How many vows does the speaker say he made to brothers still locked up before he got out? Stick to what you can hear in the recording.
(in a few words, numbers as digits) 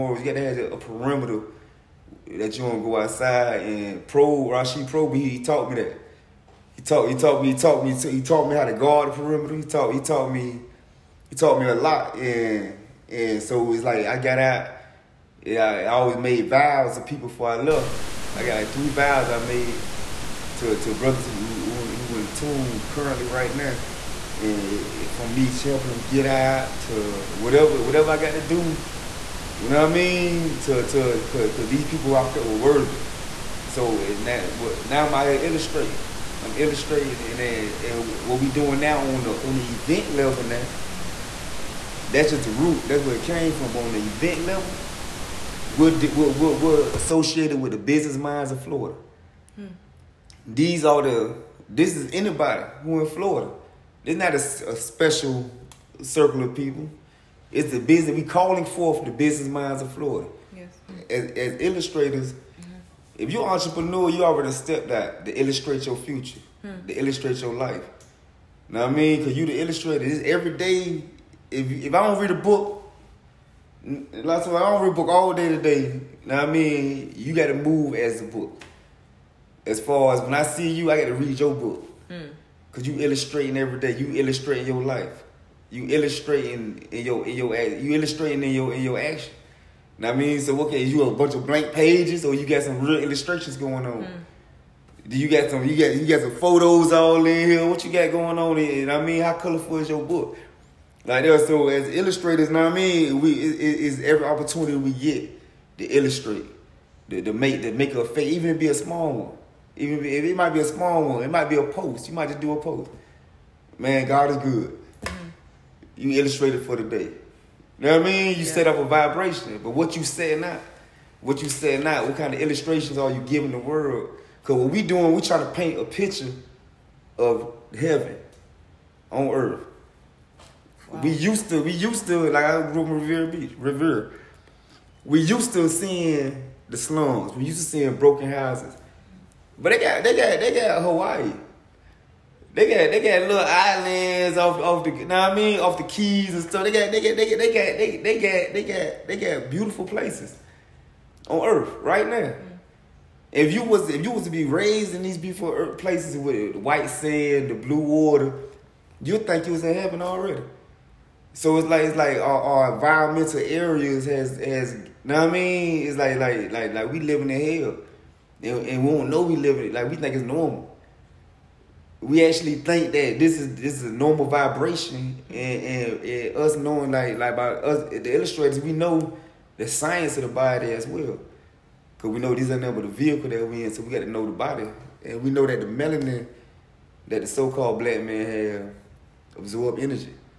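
3.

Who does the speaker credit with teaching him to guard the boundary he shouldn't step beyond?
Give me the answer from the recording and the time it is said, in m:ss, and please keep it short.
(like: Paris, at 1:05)
Pro Rashid Pro, at 0:04.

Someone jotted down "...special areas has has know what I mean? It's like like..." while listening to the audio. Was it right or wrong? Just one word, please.
wrong.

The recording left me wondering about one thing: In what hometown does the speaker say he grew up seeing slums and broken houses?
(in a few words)
Riviera Beach.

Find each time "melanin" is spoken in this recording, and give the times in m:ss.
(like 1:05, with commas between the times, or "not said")
3:05.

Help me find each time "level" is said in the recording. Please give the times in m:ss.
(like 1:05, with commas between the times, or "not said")
0:40, 0:44.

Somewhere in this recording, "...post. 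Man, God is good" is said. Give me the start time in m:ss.
1:52.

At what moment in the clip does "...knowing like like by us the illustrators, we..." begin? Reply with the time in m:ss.
2:56.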